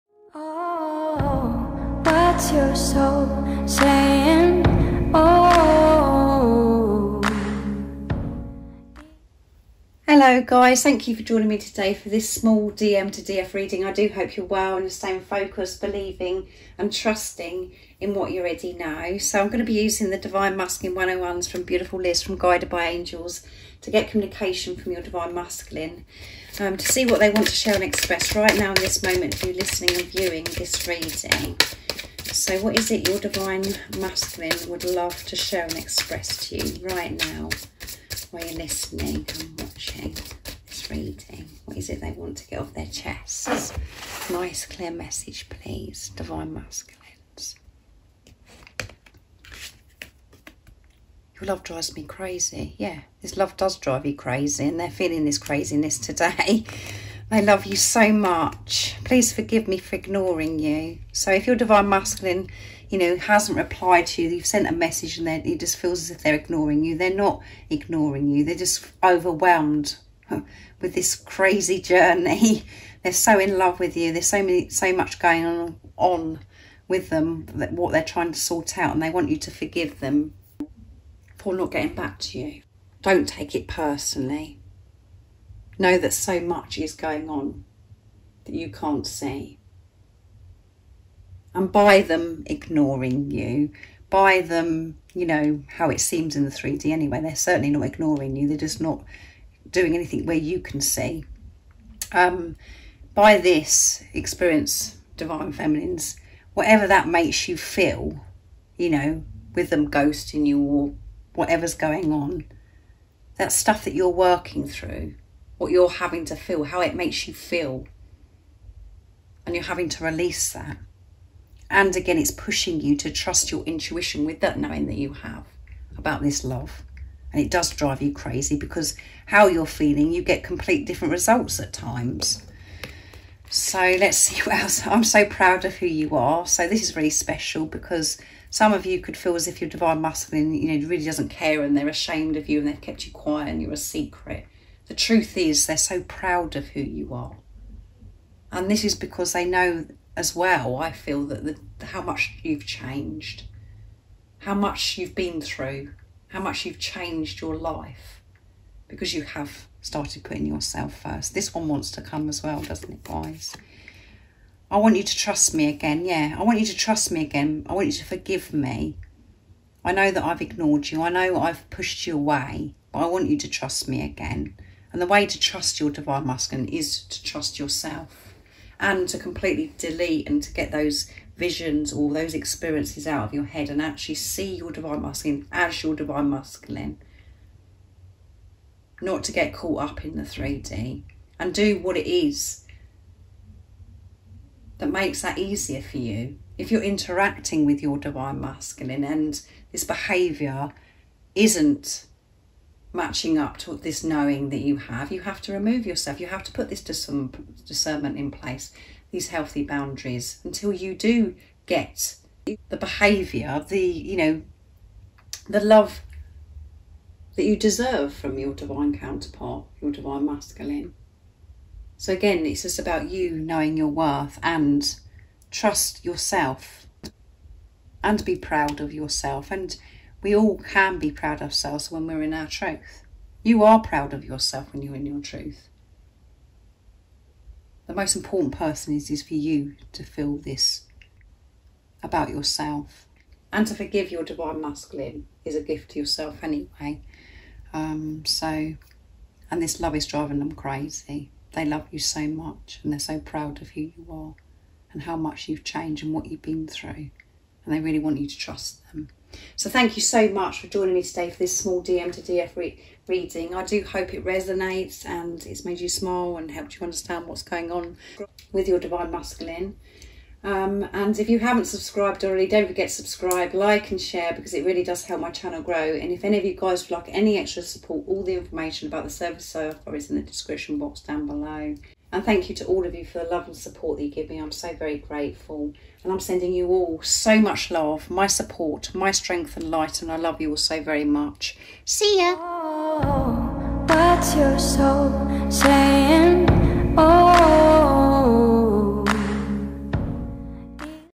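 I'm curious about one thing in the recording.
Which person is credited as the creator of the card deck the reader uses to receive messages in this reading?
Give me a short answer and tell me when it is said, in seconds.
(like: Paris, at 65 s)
Liz, at 22 s.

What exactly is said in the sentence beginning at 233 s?
You are proud of yourself when you're in your truth.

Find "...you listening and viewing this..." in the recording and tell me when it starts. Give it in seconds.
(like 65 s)
29 s.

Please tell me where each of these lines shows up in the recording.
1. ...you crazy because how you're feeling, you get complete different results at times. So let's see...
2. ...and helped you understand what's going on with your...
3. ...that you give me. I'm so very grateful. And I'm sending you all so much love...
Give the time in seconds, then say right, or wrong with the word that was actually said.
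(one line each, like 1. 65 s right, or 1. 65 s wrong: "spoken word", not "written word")
1. 128 s right
2. 266 s right
3. 283 s right.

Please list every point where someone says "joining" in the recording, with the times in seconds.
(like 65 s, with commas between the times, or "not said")
11 s, 260 s.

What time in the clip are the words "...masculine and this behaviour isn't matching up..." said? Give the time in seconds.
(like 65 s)
198 s.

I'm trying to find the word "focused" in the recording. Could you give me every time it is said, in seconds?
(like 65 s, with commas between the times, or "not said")
15 s.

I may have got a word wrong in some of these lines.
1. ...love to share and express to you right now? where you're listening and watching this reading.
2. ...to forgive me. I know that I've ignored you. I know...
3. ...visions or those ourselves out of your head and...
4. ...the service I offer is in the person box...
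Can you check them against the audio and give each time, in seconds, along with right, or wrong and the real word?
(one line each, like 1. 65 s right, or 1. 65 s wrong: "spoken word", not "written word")
1. 34 s right
2. 167 s right
3. 181 s wrong: "experiences", not "ourselves"
4. 279 s wrong: "description", not "person".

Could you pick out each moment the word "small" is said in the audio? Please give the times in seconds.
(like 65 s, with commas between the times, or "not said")
12 s, 261 s.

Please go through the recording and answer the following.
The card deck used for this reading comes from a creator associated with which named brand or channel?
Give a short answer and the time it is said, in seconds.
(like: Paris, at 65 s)
Guided by Angels, at 22 s.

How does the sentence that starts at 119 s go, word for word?
And you're having to release that.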